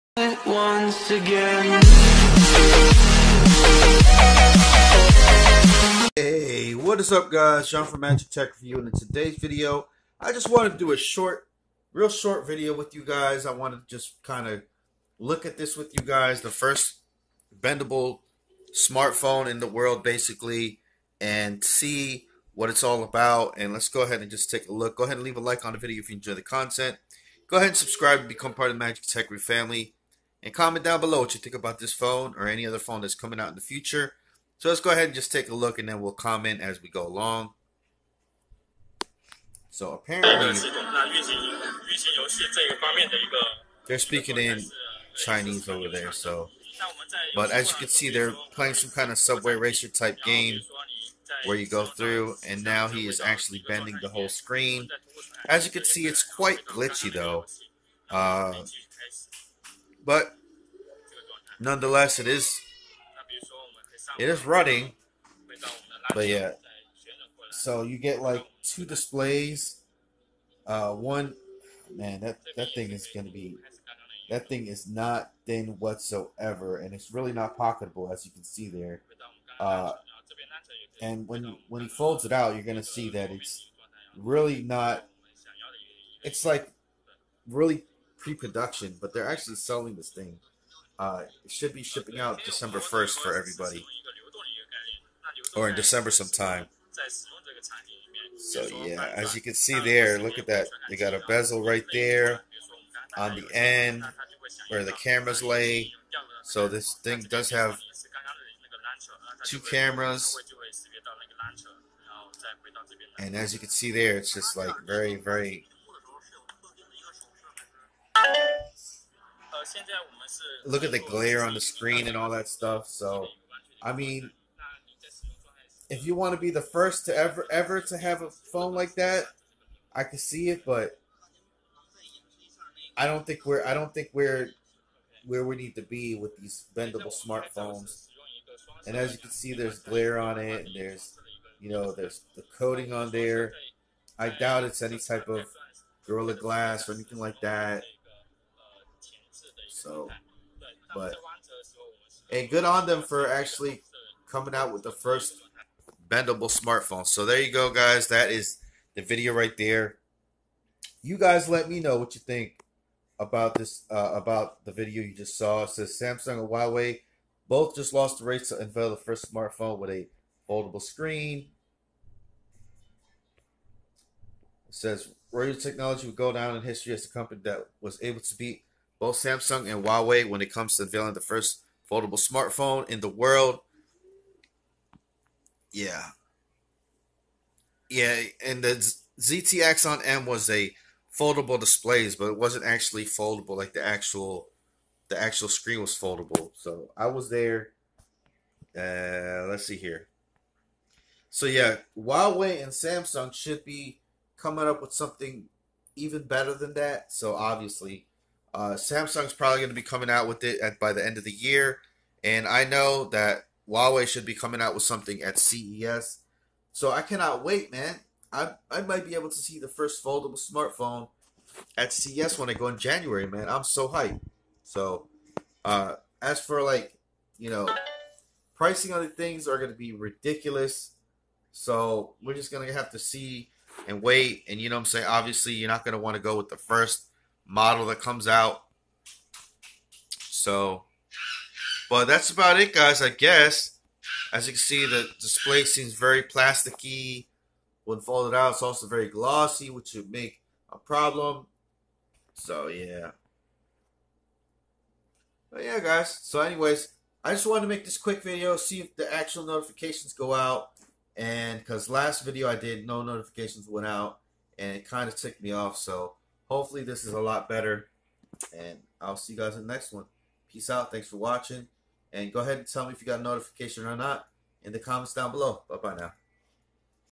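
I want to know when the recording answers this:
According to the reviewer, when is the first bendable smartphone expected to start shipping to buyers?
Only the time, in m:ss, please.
1:32.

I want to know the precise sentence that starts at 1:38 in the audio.
So yeah, as you can see there, look at that.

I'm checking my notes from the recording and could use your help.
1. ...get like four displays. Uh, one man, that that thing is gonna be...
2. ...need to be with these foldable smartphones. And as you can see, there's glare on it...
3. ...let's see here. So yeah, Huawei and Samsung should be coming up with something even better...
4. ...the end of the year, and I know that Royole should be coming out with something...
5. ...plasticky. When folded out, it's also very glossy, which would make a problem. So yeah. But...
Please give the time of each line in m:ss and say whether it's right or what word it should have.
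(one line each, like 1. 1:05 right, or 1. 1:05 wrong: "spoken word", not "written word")
1. 1:07 wrong: "two", not "four"
2. 2:15 wrong: "bendable", not "foldable"
3. 3:19 right
4. 3:30 wrong: "Huawei", not "Royole"
5. 4:06 right.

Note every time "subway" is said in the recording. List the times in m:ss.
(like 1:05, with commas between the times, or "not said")
0:49.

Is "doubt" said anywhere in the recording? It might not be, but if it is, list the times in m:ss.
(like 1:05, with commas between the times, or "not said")
2:24.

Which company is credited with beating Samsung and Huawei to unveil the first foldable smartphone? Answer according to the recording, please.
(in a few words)
Royole Technology.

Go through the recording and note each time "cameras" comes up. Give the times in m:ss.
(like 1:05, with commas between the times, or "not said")
1:44, 1:49.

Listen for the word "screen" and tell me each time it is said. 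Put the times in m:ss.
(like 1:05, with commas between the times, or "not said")
0:54, 2:01, 2:50, 3:15.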